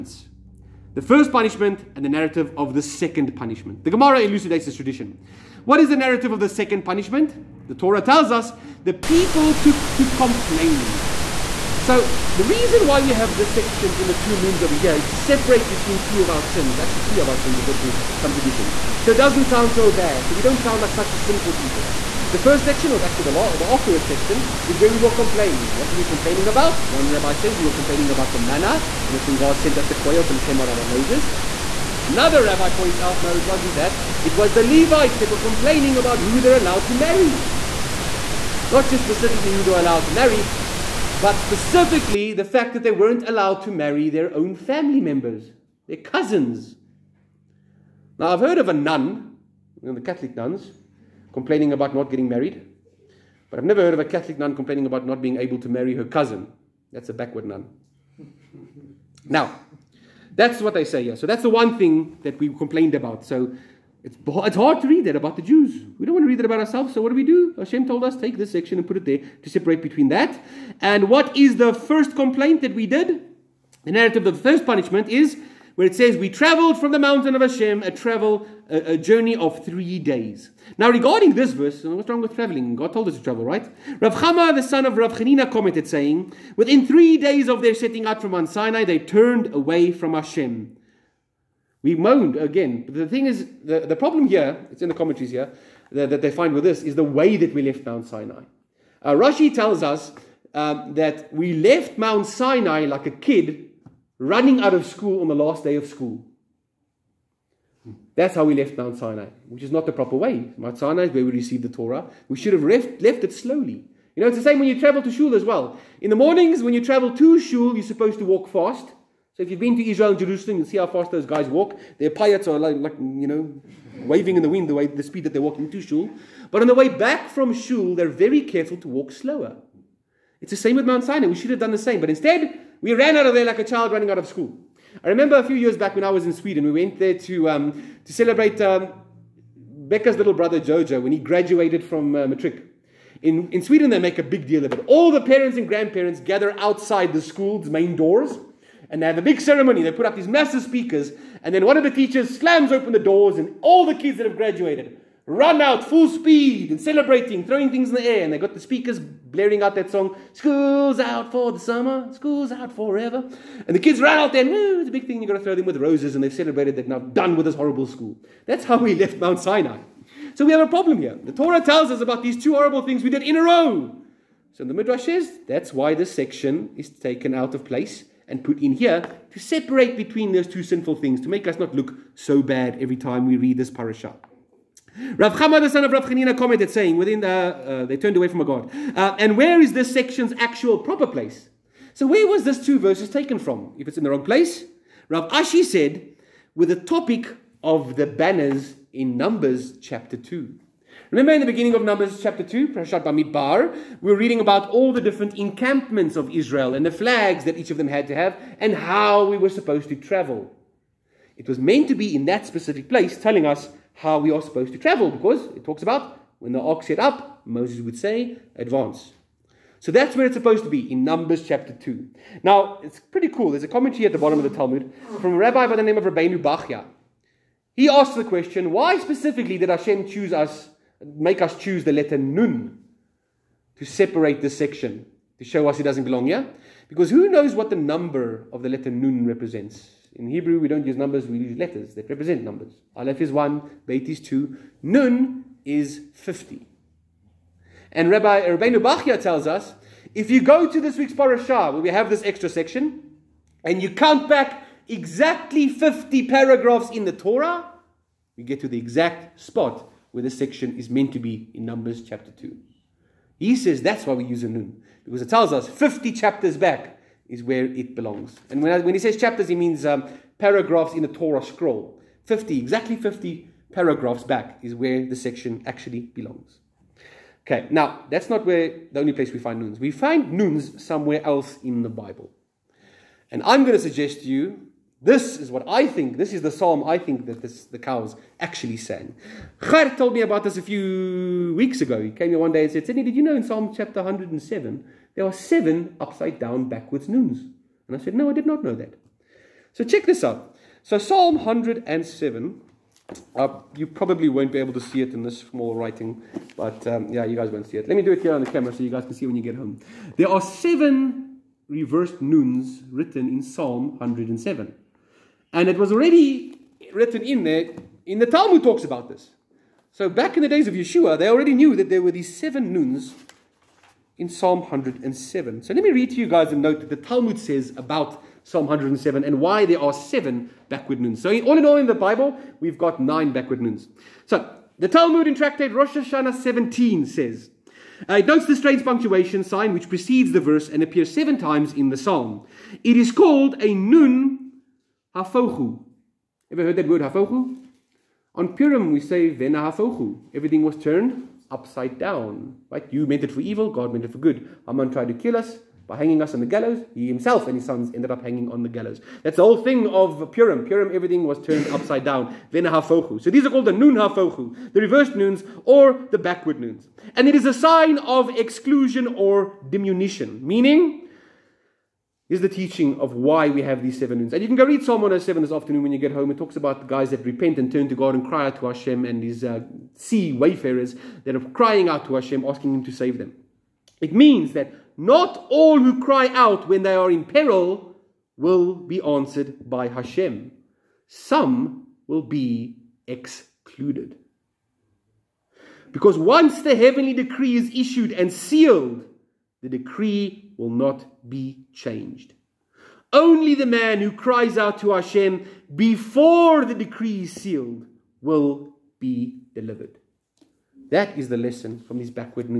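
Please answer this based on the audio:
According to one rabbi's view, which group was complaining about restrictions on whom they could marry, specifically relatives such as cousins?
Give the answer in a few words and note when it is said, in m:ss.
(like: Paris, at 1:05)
The Levites, at 0:34.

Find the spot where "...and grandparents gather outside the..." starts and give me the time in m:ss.
2:25.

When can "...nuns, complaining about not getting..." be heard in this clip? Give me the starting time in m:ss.
0:50.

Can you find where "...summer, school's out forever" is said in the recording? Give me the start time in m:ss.
2:41.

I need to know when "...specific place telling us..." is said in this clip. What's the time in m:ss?
3:32.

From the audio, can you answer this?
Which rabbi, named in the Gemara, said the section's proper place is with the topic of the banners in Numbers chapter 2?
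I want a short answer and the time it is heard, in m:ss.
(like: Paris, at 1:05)
Rav Ashi, at 3:15.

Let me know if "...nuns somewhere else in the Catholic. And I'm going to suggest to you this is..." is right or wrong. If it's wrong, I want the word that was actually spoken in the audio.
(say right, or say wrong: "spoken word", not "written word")
wrong: "Bible", not "Catholic".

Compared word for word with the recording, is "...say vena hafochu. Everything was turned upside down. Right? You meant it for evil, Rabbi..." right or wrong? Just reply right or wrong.
wrong.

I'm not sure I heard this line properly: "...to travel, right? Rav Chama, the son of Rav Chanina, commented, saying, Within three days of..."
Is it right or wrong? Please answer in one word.
right.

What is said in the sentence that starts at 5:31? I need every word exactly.
So all in all in the Bible, we've got nine backward noons.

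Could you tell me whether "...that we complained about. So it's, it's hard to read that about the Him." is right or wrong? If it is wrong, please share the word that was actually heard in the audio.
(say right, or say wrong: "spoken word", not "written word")
wrong: "Jews", not "Him".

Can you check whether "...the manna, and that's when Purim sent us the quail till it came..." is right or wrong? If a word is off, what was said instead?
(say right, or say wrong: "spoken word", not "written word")
wrong: "God", not "Purim".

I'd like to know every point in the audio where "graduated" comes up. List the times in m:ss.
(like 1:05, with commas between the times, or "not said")
2:21, 2:34.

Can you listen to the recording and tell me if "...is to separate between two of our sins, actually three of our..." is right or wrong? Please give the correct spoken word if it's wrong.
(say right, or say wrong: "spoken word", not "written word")
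right.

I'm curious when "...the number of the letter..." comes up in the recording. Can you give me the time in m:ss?
3:57.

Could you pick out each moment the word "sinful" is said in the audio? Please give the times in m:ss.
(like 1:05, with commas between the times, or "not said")
0:21, 3:00.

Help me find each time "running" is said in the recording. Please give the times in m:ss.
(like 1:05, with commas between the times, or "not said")
1:44, 2:13.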